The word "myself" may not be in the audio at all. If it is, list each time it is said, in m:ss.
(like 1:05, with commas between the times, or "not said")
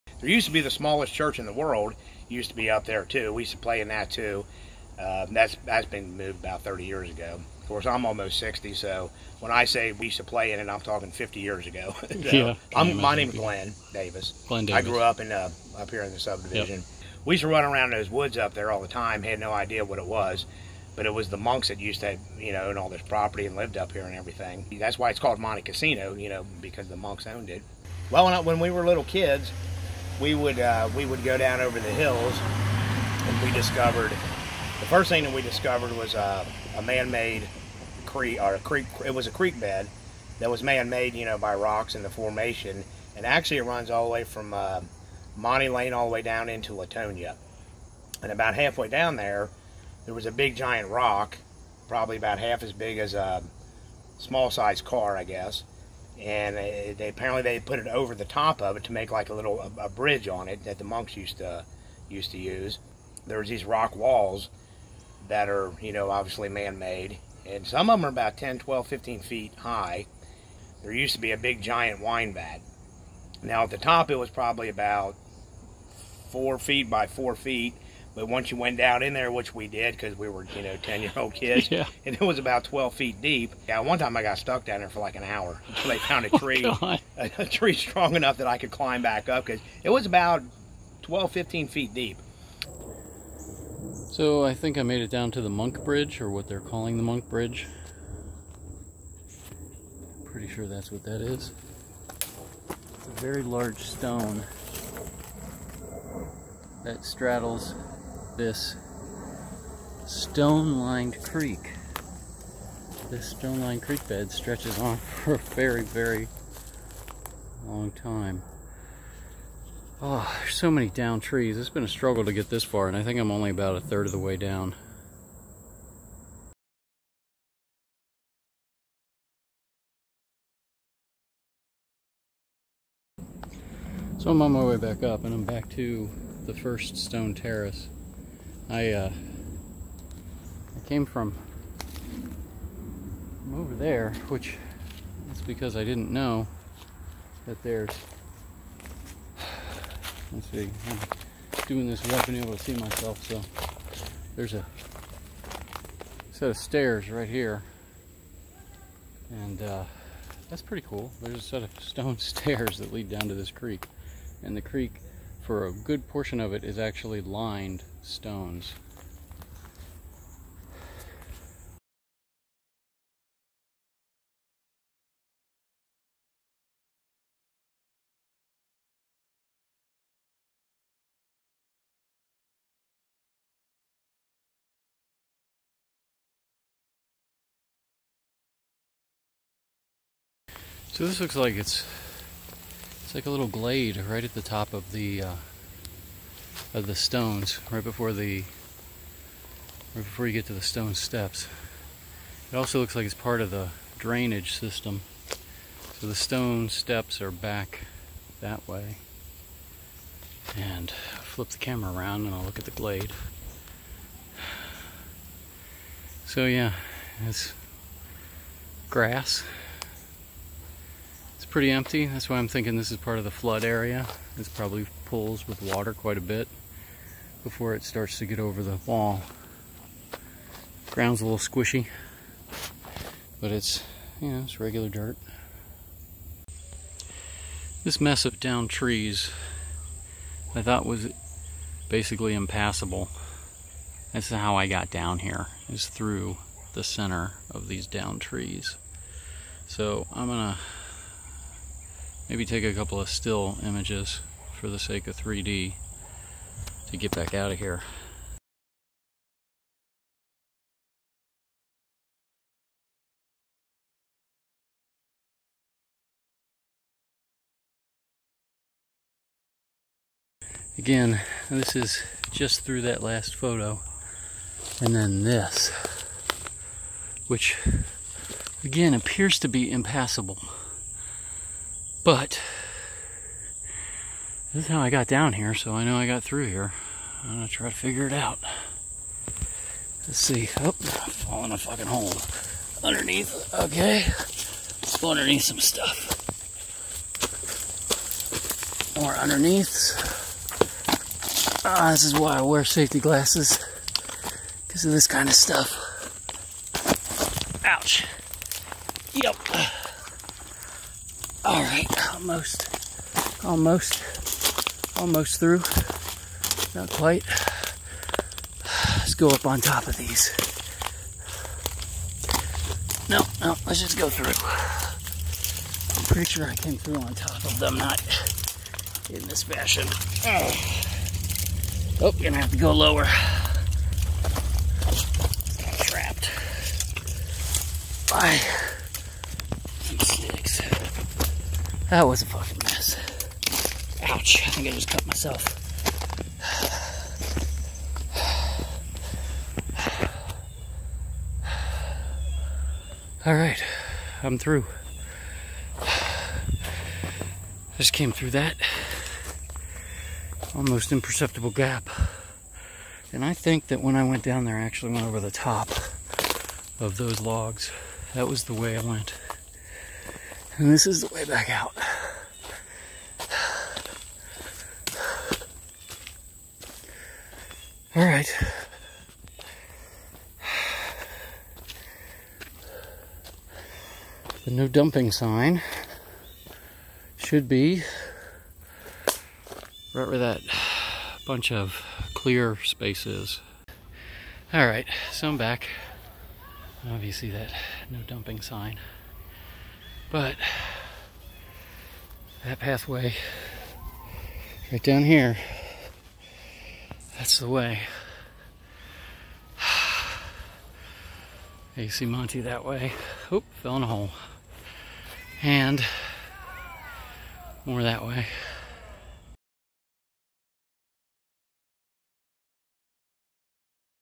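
2:32, 5:45.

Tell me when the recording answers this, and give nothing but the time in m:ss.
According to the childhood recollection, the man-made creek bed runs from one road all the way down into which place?
0:46.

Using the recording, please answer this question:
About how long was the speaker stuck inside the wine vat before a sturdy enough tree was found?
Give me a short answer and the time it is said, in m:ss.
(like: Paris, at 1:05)
an hour, at 1:24.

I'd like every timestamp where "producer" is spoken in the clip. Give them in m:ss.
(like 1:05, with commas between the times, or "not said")
not said.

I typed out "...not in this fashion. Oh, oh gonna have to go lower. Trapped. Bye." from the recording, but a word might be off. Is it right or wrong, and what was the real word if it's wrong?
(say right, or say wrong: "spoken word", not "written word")
right.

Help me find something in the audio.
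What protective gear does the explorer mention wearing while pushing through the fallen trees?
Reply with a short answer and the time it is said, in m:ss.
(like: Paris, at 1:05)
safety glasses, at 5:02.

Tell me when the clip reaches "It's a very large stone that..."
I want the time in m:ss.
1:42.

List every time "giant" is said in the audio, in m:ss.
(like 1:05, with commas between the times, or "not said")
0:50, 1:11.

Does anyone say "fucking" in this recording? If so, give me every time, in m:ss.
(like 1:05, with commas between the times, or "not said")
4:51, 5:42.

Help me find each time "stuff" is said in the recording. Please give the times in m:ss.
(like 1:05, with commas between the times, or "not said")
4:55, 5:05.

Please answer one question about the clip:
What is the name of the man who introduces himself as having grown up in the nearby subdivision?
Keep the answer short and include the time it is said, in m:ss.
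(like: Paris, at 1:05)
Glenn Davis, at 0:12.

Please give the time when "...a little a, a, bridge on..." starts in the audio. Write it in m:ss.
0:59.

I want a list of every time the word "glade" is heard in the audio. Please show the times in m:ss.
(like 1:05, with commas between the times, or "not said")
3:13, 3:32.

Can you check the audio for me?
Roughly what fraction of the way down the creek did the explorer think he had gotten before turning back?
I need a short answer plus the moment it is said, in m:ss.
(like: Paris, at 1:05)
a third, at 2:03.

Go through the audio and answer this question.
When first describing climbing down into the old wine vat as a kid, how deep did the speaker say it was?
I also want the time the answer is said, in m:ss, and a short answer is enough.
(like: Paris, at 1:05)
12 feet, at 1:22.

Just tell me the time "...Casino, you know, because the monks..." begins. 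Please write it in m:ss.
0:25.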